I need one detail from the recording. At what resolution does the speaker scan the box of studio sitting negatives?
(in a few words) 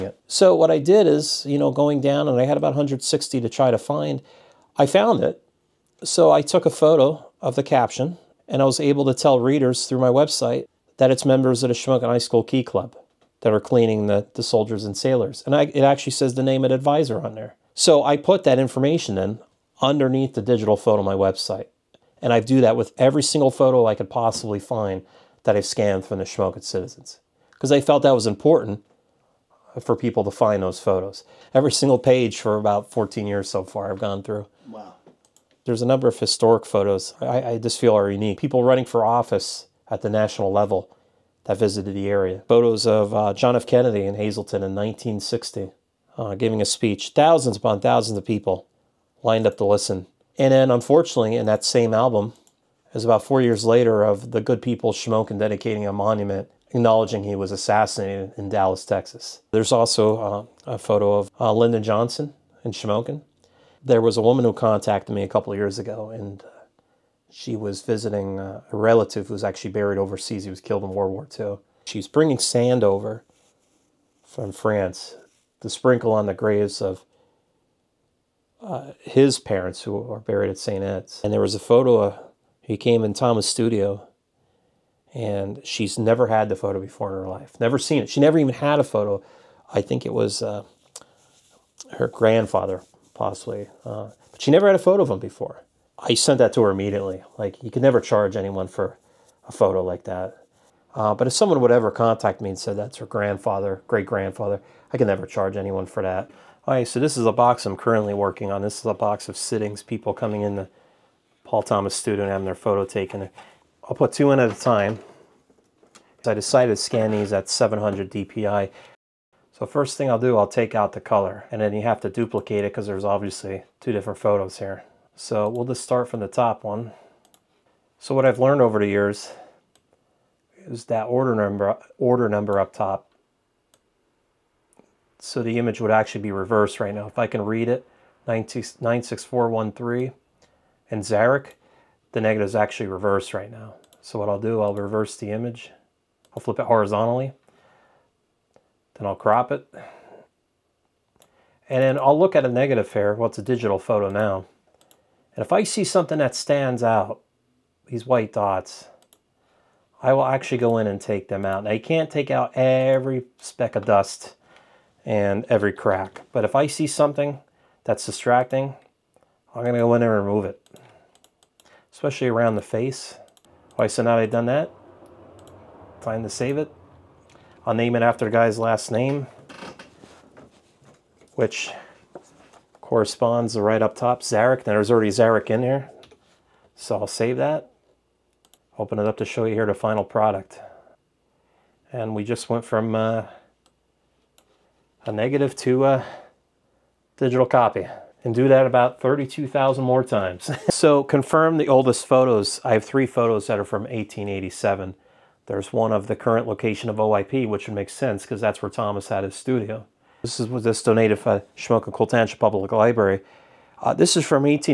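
700 dpi.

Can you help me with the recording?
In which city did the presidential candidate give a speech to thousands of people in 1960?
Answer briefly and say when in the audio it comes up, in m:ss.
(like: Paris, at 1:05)
Hazleton, at 0:44.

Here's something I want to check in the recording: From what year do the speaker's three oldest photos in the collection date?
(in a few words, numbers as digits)
1887.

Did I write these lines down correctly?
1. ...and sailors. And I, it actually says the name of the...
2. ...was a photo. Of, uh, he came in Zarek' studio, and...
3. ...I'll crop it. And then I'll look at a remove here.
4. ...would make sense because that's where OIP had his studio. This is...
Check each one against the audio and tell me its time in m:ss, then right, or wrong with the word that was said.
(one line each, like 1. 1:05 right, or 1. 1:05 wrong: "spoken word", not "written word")
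1. 0:14 right
2. 1:21 wrong: "Thomas", not "Zarek"
3. 2:29 wrong: "negative", not "remove"
4. 3:27 wrong: "Thomas", not "OIP".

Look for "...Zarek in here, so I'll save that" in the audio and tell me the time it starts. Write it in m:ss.
3:05.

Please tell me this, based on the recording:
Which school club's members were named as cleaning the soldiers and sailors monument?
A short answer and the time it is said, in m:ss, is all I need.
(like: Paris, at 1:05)
Shamokin High School Key Club, at 0:11.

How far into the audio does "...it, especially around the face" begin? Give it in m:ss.
2:50.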